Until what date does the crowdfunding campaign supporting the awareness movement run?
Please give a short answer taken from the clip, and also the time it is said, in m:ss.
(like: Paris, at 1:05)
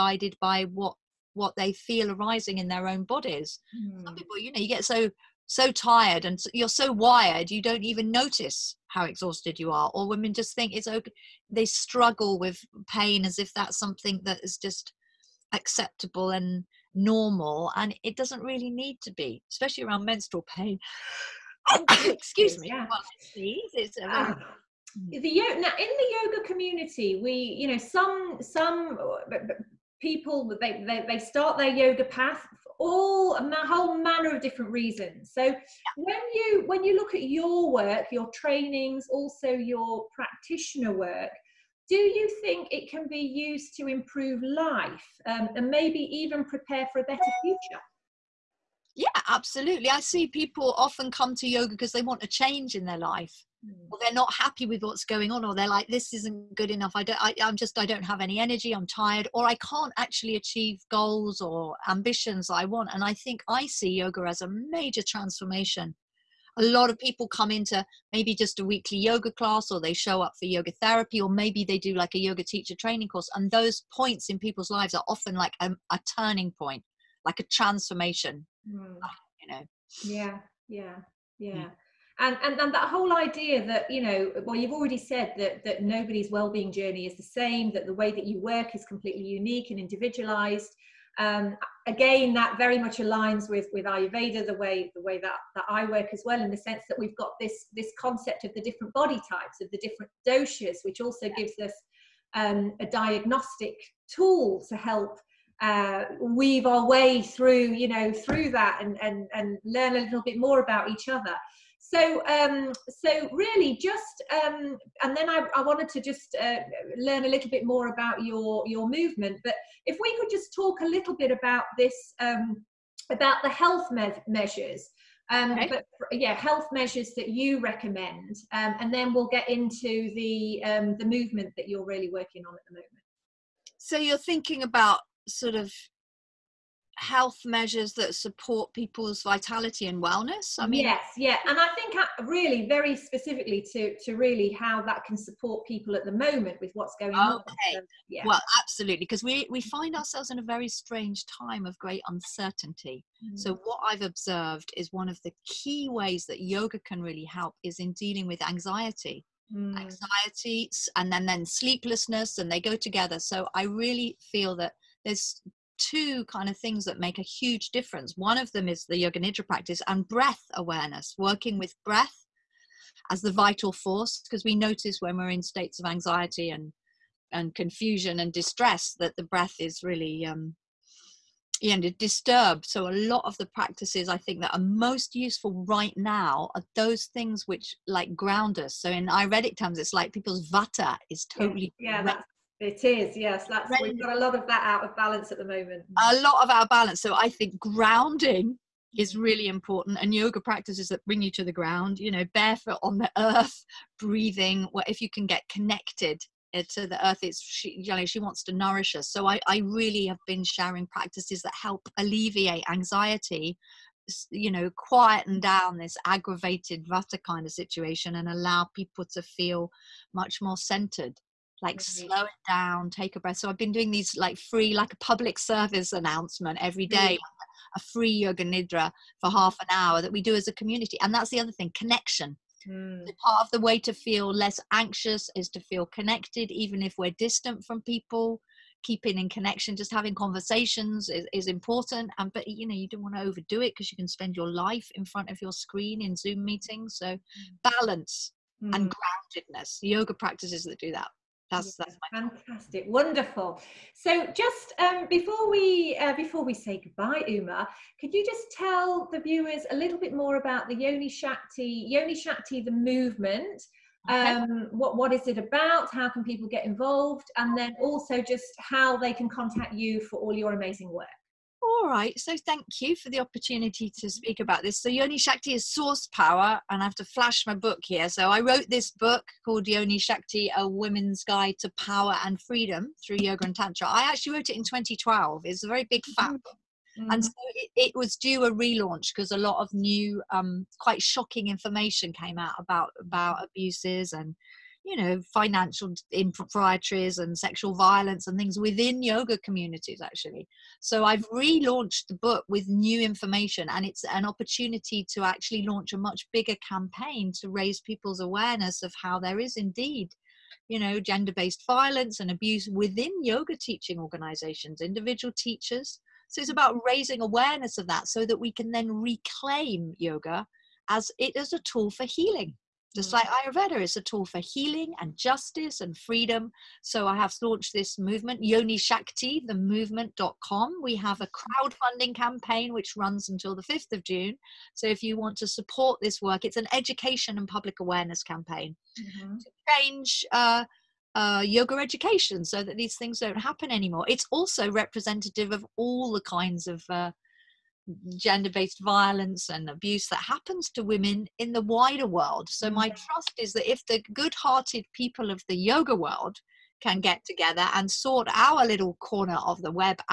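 5 June, at 5:33.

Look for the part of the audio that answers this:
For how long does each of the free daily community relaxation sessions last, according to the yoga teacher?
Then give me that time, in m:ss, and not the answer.
3:49.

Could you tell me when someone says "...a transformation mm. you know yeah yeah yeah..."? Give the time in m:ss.
1:17.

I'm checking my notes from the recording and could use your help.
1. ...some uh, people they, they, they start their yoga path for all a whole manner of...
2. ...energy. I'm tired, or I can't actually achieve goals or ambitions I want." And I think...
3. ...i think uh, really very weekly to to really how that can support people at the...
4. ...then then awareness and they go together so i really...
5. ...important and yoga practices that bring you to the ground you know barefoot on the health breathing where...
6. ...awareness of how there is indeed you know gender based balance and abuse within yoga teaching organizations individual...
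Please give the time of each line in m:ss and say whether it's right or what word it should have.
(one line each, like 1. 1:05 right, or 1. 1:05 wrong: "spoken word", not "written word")
1. 0:28 right
2. 0:58 right
3. 2:21 wrong: "specifically", not "weekly"
4. 2:41 wrong: "sleeplessness", not "awareness"
5. 3:19 wrong: "earth", not "health"
6. 5:08 wrong: "violence", not "balance".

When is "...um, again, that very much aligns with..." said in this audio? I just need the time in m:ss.
1:31.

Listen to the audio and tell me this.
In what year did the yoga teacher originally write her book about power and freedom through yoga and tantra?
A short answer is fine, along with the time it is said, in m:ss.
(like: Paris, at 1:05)
2012, at 4:44.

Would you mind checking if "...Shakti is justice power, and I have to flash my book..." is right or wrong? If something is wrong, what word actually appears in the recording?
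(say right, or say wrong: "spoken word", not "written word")
wrong: "source", not "justice".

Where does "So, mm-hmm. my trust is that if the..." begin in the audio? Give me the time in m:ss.
5:52.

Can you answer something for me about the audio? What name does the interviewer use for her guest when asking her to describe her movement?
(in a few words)
Uma.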